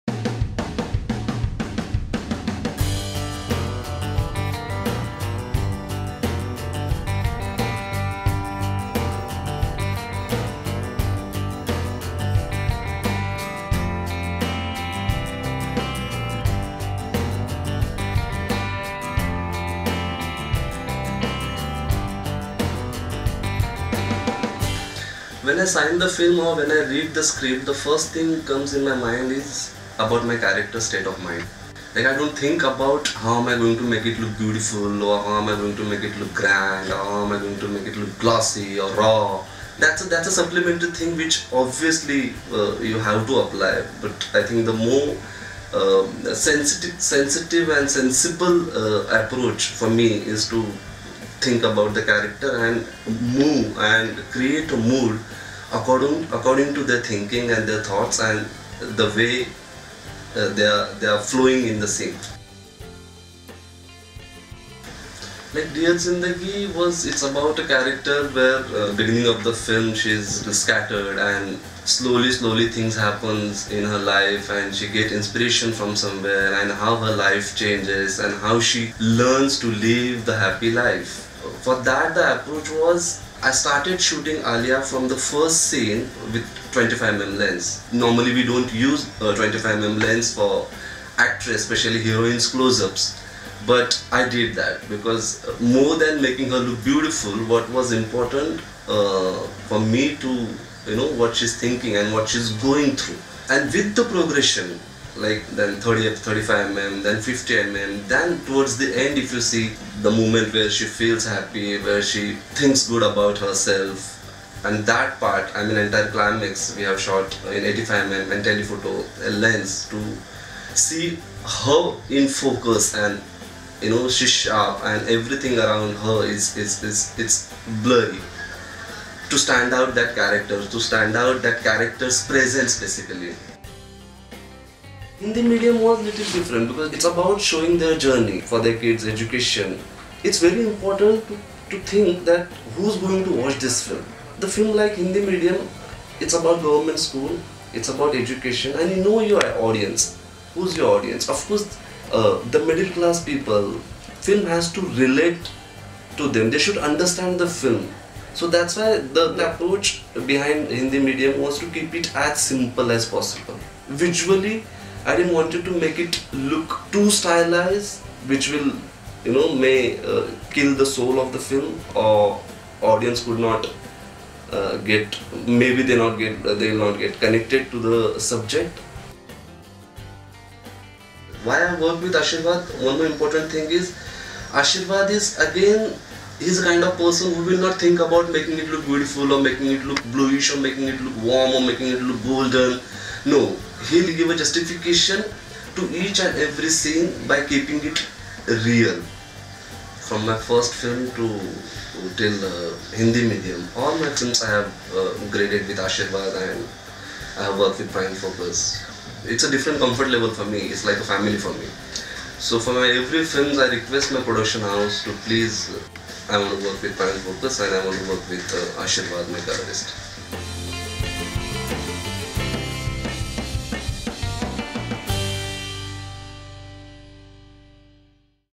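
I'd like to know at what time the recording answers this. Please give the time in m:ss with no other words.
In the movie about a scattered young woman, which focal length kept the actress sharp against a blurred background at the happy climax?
1:57.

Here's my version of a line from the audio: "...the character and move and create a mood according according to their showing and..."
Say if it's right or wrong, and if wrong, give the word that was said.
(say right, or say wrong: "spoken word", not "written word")
wrong: "thinking", not "showing".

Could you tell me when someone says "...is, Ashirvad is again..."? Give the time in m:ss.
3:03.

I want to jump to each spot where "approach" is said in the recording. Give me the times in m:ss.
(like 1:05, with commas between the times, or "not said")
0:49, 1:22, 2:39.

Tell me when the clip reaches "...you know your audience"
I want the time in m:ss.
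2:28.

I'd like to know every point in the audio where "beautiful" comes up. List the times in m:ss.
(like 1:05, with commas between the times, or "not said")
0:34, 1:36, 3:08.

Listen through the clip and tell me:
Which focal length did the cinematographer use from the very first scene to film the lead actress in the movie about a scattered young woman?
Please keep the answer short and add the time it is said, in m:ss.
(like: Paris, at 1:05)
25mm, at 1:26.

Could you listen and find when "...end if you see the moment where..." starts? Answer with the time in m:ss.
1:48.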